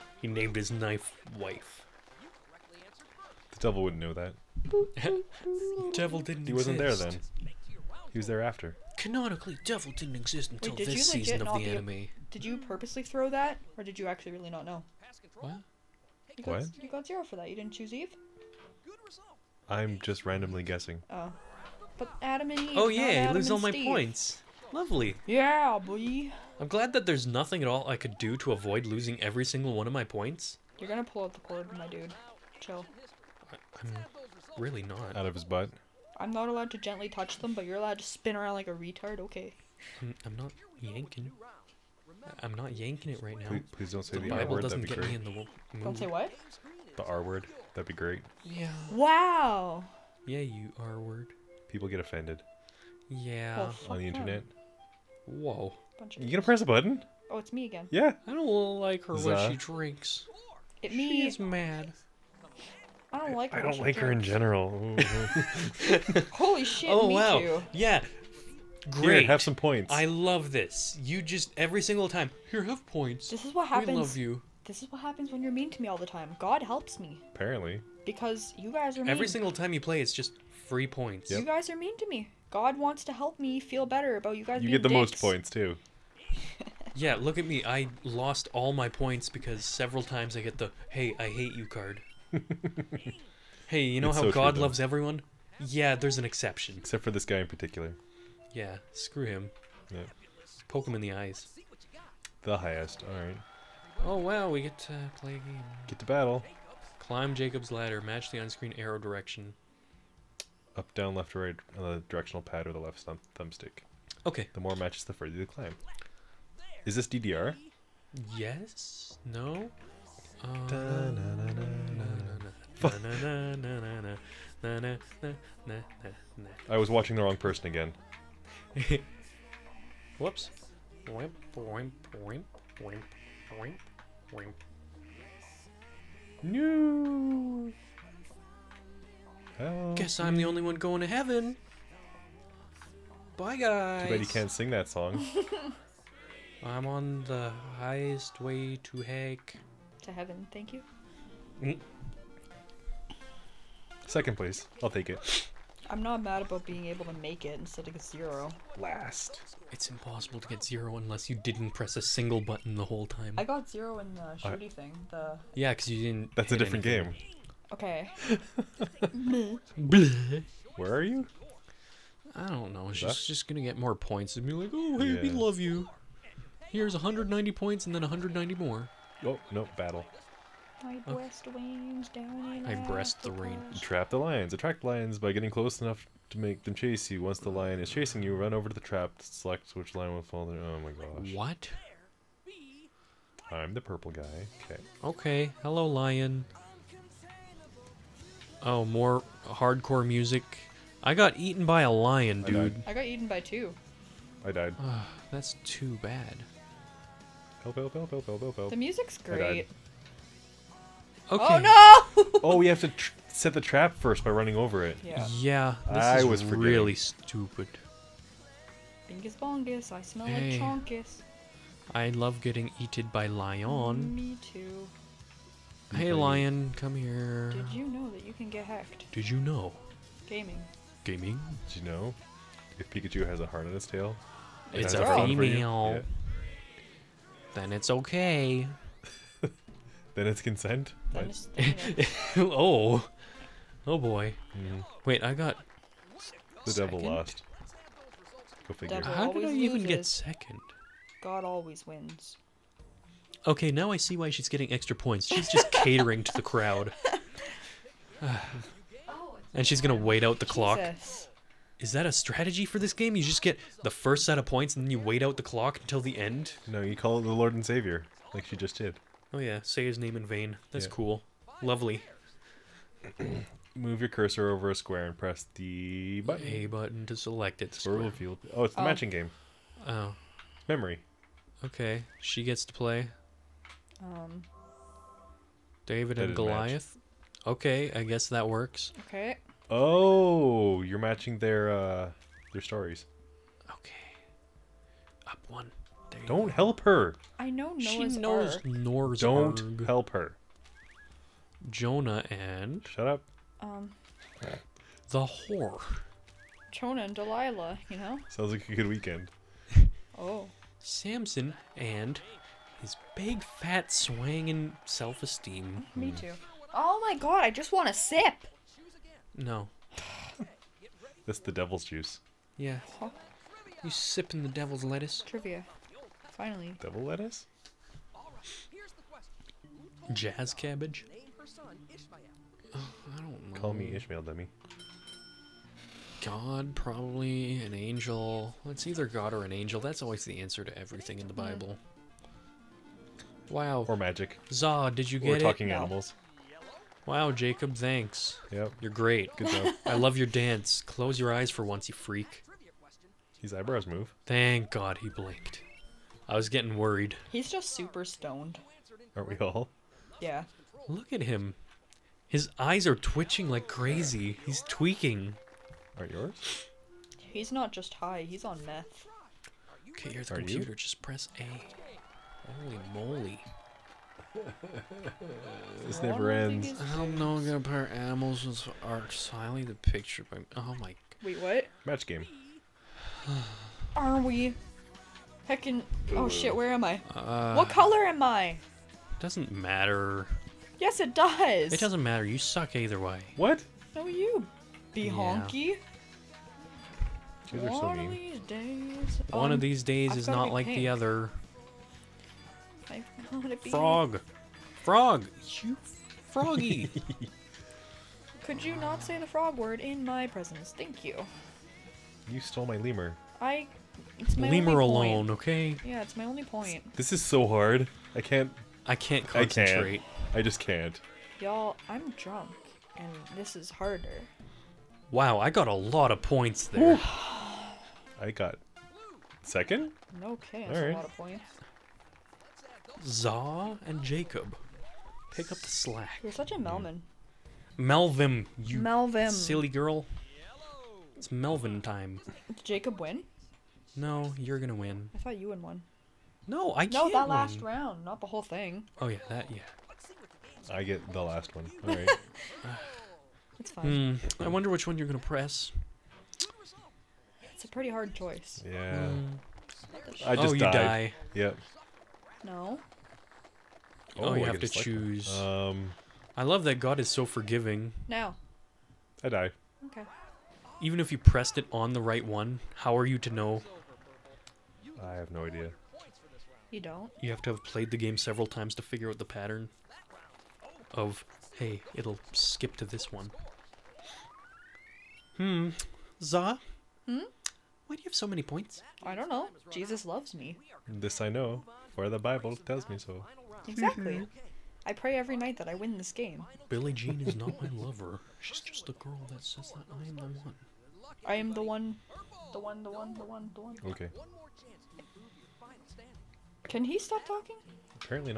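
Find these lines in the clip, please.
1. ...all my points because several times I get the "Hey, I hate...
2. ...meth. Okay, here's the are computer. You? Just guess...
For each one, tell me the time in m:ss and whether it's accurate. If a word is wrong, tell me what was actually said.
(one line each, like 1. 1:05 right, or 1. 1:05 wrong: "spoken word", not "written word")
1. 1:28 right
2. 6:08 wrong: "press", not "guess".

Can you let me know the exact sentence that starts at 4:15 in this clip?
She's just catering to the crowd.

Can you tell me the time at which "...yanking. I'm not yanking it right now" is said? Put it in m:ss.
0:40.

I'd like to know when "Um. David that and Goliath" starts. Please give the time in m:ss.
4:44.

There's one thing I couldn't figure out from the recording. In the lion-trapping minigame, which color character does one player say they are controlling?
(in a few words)
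Purple.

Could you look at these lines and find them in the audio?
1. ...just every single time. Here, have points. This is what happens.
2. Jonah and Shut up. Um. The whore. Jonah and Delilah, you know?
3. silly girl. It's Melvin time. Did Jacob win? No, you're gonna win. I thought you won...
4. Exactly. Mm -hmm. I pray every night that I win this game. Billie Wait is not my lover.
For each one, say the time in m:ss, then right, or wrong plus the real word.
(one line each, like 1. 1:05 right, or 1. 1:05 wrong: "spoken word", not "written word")
1. 1:11 right
2. 5:01 right
3. 7:19 right
4. 8:13 wrong: "Jean", not "Wait".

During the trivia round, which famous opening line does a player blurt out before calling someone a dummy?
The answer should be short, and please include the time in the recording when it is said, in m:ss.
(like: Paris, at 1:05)
Call me Ishmael, at 5:33.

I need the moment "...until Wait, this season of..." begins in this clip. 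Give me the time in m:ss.
0:10.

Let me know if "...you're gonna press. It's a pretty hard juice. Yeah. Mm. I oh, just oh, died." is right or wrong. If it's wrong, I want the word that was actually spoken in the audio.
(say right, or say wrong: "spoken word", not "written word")
wrong: "choice", not "juice".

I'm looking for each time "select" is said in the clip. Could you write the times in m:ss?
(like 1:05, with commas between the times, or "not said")
3:09, 4:37.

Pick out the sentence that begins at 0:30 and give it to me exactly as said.
You're gonna pull out the cord, my dude.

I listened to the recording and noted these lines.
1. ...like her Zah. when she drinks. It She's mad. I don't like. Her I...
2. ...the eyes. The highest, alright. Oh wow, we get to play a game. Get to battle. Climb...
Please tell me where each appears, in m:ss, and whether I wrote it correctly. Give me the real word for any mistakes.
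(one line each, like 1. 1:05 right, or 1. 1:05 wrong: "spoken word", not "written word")
1. 0:58 right
2. 1:41 right.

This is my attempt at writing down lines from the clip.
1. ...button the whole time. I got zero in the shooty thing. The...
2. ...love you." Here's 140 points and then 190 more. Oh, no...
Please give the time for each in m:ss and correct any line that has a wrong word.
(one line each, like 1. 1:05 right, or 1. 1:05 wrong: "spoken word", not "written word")
1. 2:42 right
2. 2:55 wrong: "190", not "140".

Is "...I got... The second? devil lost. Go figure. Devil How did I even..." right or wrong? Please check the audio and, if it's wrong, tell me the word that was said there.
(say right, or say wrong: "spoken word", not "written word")
right.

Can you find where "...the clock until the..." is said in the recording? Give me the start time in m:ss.
4:25.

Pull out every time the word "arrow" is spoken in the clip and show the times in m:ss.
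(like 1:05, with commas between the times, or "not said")
1:48.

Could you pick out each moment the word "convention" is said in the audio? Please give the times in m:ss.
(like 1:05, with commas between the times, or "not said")
not said.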